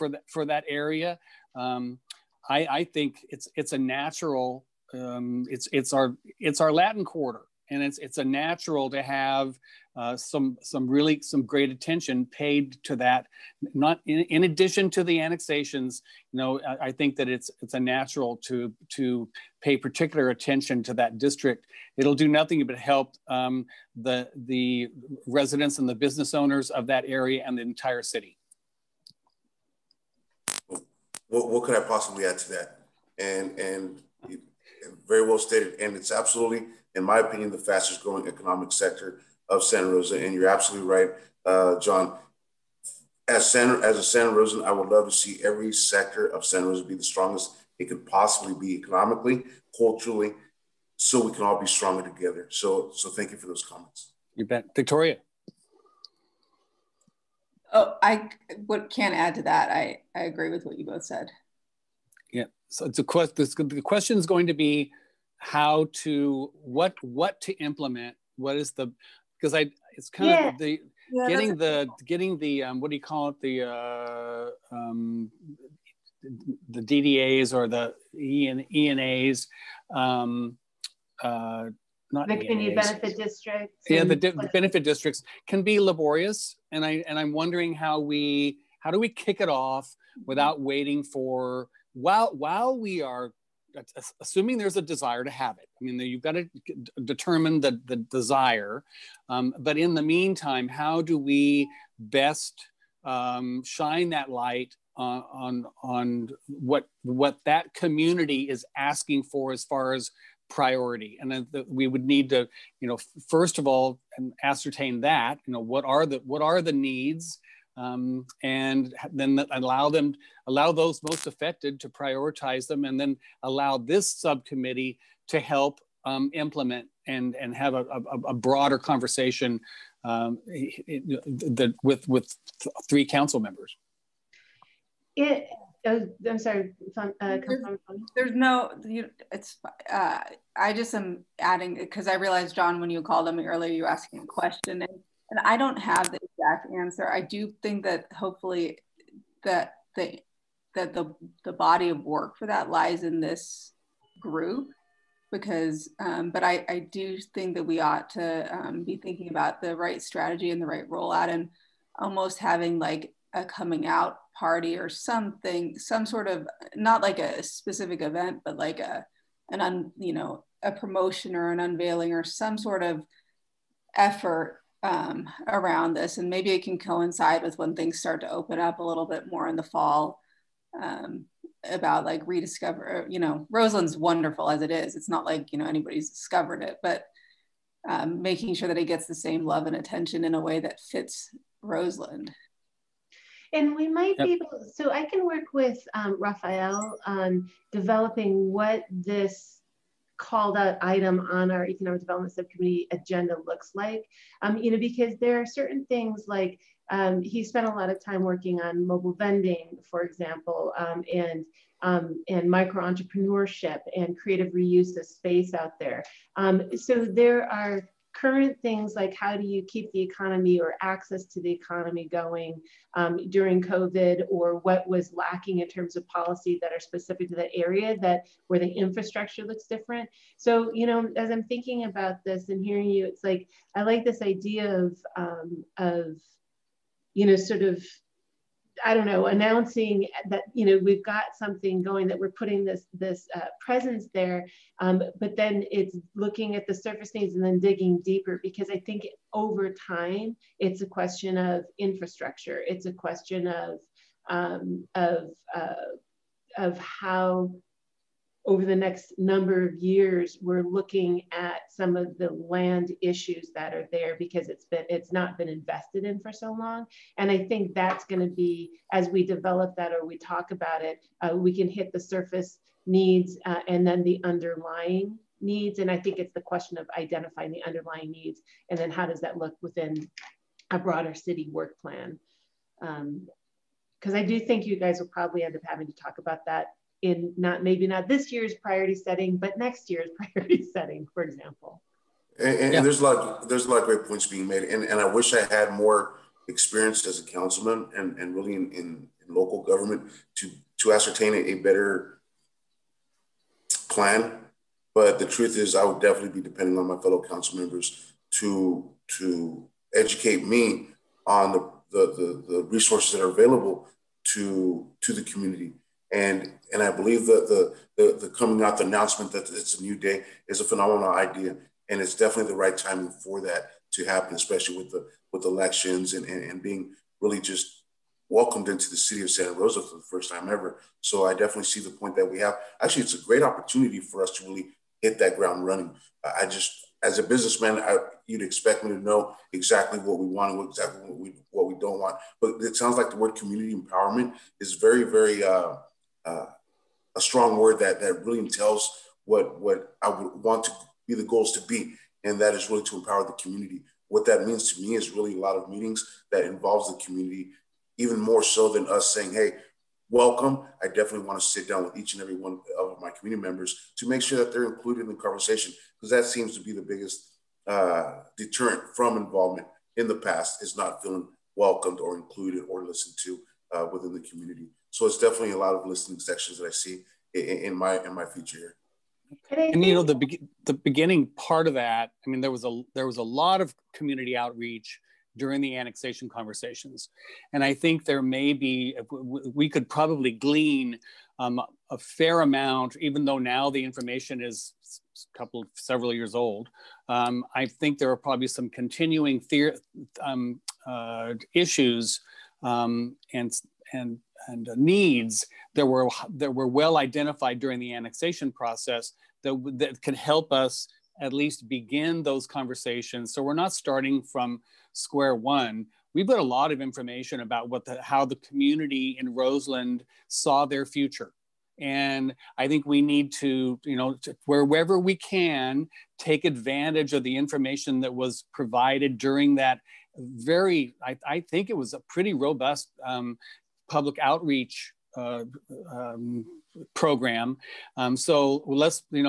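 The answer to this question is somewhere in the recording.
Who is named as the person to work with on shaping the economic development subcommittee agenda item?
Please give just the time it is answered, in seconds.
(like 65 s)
196 s.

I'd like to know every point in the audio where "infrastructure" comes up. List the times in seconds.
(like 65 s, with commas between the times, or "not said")
228 s, 251 s.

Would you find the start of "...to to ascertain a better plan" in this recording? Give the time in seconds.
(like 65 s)
300 s.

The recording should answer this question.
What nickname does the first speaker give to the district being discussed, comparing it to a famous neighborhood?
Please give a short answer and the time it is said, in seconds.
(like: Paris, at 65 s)
Latin Quarter, at 6 s.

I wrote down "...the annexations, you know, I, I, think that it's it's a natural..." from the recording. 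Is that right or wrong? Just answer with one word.
right.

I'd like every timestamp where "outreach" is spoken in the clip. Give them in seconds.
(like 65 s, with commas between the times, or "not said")
384 s, 434 s.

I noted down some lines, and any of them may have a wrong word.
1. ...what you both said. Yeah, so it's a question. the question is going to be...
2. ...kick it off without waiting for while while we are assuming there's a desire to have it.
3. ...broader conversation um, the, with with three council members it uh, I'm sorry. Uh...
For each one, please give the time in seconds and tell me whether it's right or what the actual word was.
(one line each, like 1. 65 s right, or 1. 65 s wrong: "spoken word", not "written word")
1. 60 s right
2. 89 s right
3. 128 s right.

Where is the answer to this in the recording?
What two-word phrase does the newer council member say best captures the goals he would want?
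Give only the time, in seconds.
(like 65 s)
343 s.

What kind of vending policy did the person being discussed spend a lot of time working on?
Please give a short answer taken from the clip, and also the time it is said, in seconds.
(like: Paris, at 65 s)
mobile vending, at 208 s.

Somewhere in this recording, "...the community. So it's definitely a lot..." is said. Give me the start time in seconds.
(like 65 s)
374 s.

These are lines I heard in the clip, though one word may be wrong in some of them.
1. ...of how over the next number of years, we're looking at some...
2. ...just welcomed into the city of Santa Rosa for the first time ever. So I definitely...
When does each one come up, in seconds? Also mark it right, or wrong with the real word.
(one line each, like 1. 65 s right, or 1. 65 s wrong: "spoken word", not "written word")
1. 256 s right
2. 327 s right.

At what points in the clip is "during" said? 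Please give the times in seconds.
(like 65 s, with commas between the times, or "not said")
223 s, 385 s, 407 s, 429 s.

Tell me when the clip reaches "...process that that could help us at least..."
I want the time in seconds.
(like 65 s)
408 s.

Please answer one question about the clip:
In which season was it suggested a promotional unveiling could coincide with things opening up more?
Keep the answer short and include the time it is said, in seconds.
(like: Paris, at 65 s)
fall, at 179 s.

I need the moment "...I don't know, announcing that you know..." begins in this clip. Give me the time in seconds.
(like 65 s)
238 s.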